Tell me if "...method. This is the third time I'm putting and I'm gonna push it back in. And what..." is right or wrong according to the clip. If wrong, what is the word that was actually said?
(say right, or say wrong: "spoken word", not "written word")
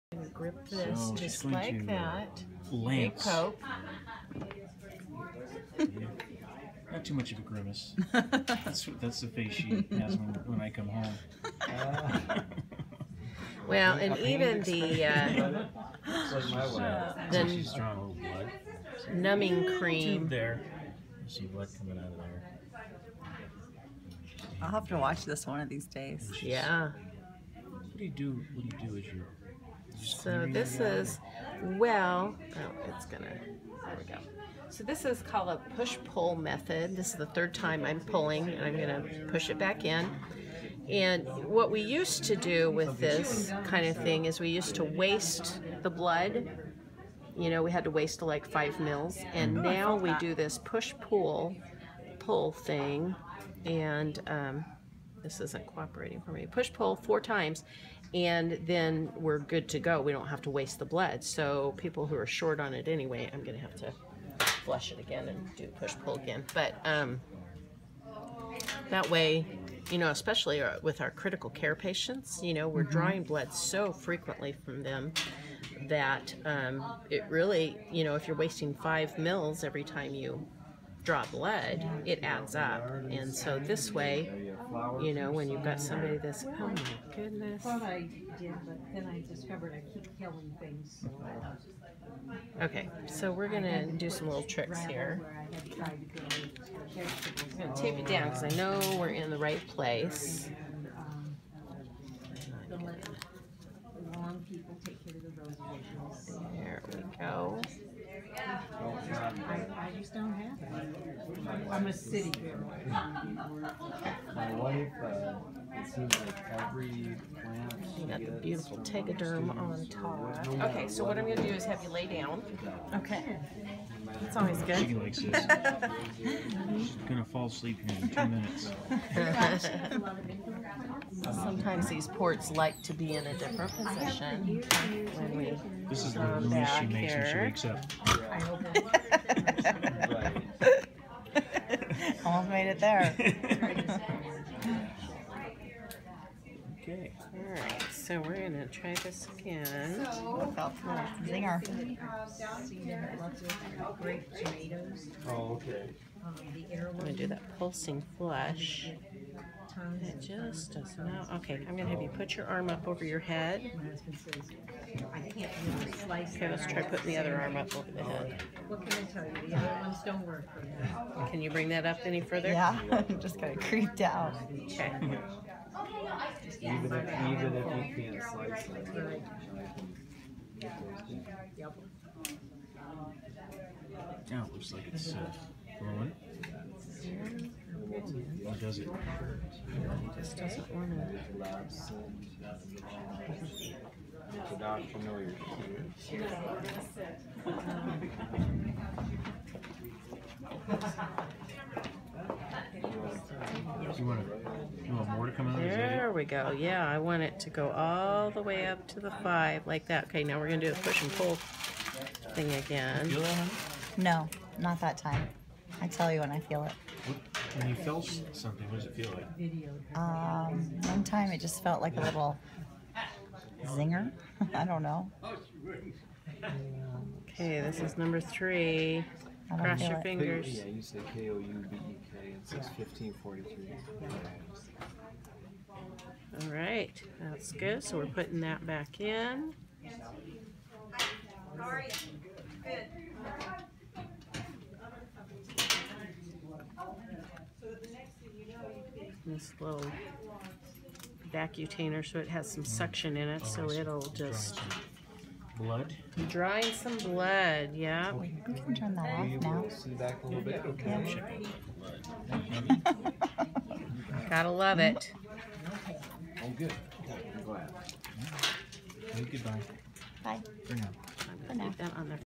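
wrong: "pulling", not "putting".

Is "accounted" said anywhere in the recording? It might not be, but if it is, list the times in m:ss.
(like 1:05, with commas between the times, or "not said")
not said.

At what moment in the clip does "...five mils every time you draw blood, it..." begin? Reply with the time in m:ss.
1:18.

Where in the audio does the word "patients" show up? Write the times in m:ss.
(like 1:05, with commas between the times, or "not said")
1:11.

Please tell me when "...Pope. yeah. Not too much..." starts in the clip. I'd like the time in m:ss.
0:03.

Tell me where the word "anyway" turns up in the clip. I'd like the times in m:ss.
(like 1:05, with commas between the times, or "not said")
1:02.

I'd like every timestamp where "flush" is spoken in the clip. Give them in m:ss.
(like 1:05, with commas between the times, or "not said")
1:04, 2:38.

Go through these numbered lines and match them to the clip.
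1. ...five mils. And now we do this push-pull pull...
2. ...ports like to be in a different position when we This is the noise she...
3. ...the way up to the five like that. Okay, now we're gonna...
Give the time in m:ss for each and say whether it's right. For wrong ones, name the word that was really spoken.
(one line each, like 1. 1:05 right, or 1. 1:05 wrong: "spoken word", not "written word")
1. 0:48 right
2. 2:12 right
3. 3:28 right.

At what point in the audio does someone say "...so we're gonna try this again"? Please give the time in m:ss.
2:28.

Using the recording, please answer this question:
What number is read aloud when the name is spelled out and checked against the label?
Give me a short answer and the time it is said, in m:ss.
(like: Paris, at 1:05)
1543, at 3:52.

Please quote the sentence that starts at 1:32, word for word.
Okay, so we're going to do some little tricks here.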